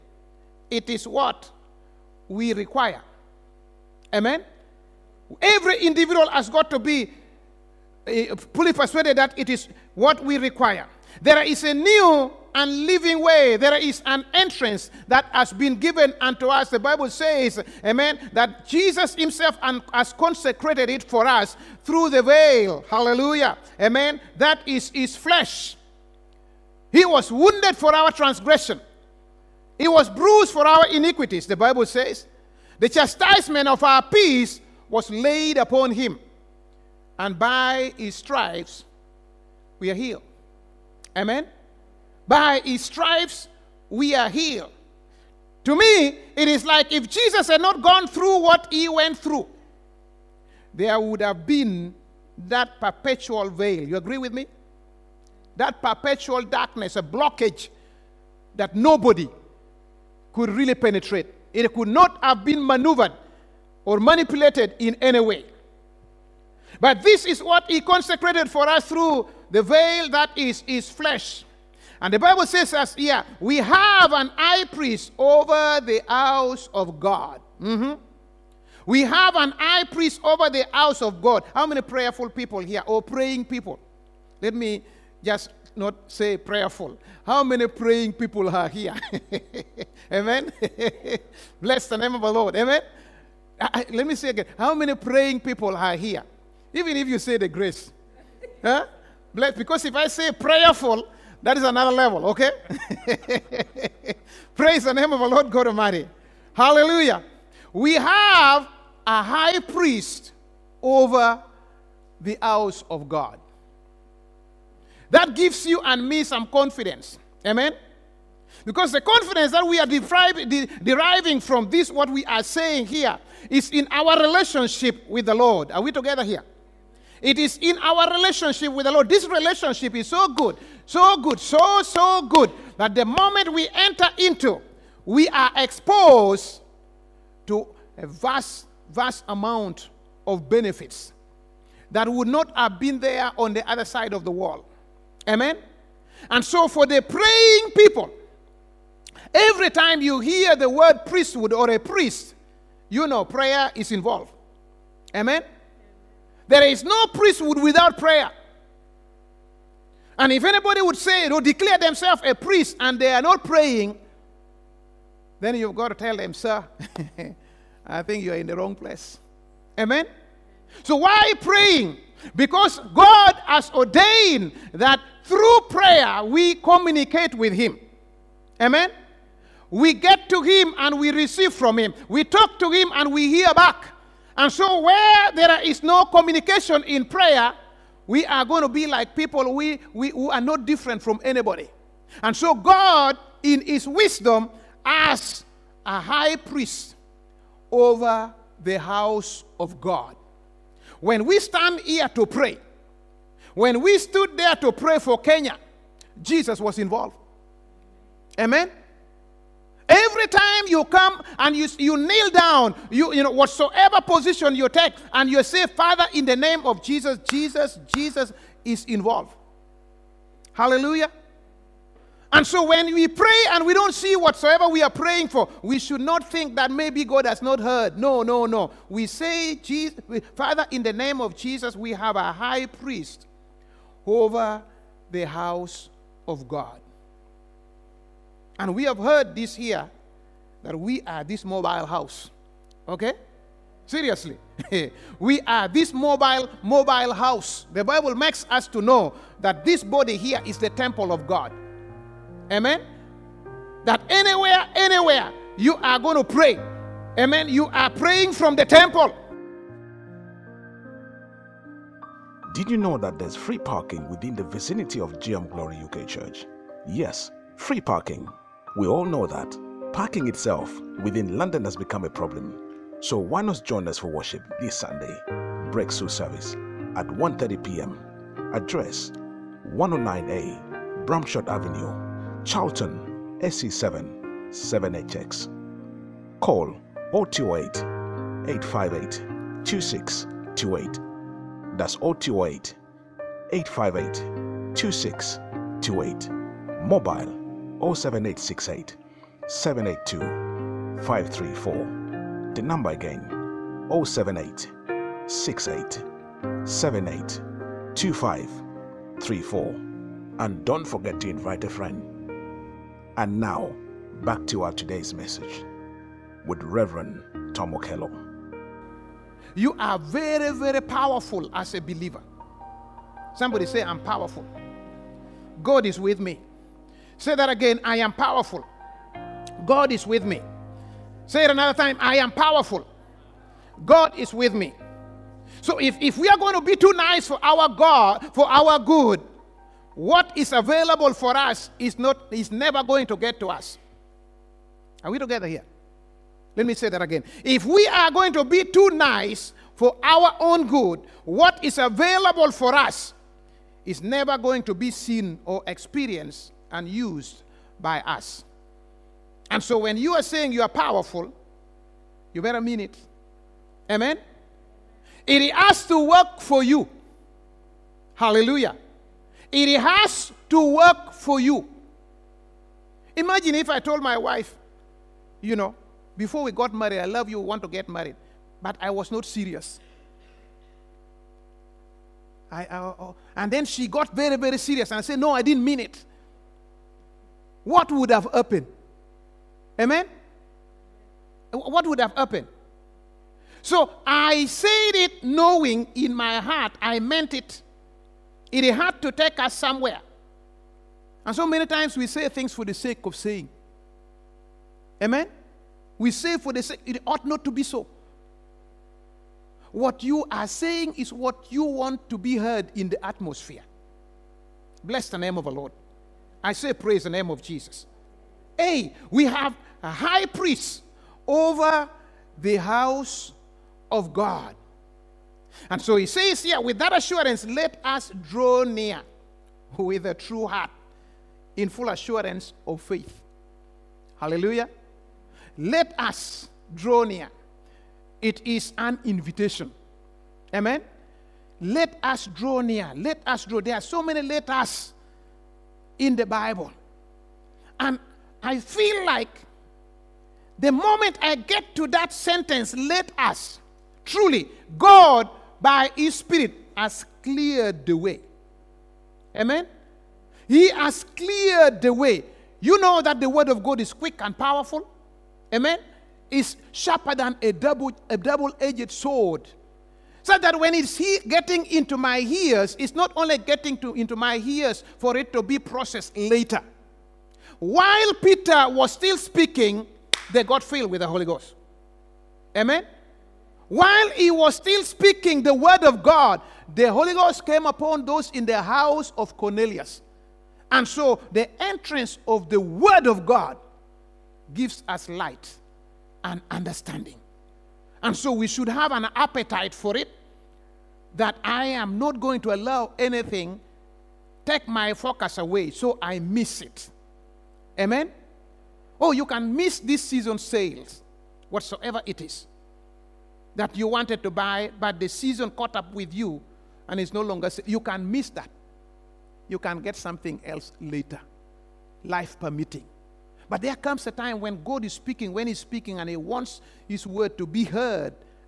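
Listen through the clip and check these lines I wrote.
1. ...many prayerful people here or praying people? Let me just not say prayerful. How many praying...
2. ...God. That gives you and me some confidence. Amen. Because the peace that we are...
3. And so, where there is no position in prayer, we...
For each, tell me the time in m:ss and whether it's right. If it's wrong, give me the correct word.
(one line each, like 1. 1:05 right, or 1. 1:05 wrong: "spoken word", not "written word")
1. 1:21 right
2. 1:53 wrong: "confidence", not "peace"
3. 3:04 wrong: "communication", not "position".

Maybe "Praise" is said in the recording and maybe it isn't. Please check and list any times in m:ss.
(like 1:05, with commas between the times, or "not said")
1:44, 6:56.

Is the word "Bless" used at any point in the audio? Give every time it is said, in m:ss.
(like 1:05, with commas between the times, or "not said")
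1:31, 1:39, 6:54.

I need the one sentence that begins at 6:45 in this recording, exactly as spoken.
We say for the sake, it ought not to be so.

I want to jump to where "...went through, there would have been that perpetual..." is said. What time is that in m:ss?
0:48.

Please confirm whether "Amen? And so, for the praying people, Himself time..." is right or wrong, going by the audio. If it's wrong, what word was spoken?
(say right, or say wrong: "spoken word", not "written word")
wrong: "Every", not "Himself".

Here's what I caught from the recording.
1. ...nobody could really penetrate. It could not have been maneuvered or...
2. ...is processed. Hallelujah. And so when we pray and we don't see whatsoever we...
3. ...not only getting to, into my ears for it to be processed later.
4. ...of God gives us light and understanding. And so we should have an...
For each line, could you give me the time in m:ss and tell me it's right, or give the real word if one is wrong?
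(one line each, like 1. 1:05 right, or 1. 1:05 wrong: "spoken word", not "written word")
1. 0:58 right
2. 3:38 wrong: "involved", not "processed"
3. 7:52 right
4. 8:13 right.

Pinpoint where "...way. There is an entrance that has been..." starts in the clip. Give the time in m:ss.
0:13.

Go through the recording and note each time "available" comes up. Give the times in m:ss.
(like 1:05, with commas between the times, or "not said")
5:40, 5:51.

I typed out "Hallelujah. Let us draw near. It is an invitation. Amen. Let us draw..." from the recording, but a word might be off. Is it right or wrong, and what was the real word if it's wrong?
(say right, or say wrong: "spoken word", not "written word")
right.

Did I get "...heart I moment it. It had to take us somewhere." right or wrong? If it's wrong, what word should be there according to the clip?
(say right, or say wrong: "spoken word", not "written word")
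wrong: "meant", not "moment".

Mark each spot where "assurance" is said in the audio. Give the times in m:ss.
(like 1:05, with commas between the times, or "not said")
7:06, 7:11.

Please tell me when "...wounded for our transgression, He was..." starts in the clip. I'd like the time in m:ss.
0:27.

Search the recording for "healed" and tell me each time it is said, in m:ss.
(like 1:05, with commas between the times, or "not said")
0:39, 0:44.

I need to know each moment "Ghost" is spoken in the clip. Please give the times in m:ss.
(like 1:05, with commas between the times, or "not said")
8:01, 8:07.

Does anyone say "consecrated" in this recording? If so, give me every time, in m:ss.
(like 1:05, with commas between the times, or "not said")
0:20, 1:07.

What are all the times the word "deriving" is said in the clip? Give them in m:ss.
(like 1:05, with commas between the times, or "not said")
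2:00.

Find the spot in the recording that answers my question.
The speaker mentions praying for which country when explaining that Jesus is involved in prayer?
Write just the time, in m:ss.
3:25.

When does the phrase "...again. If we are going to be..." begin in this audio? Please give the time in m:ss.
5:47.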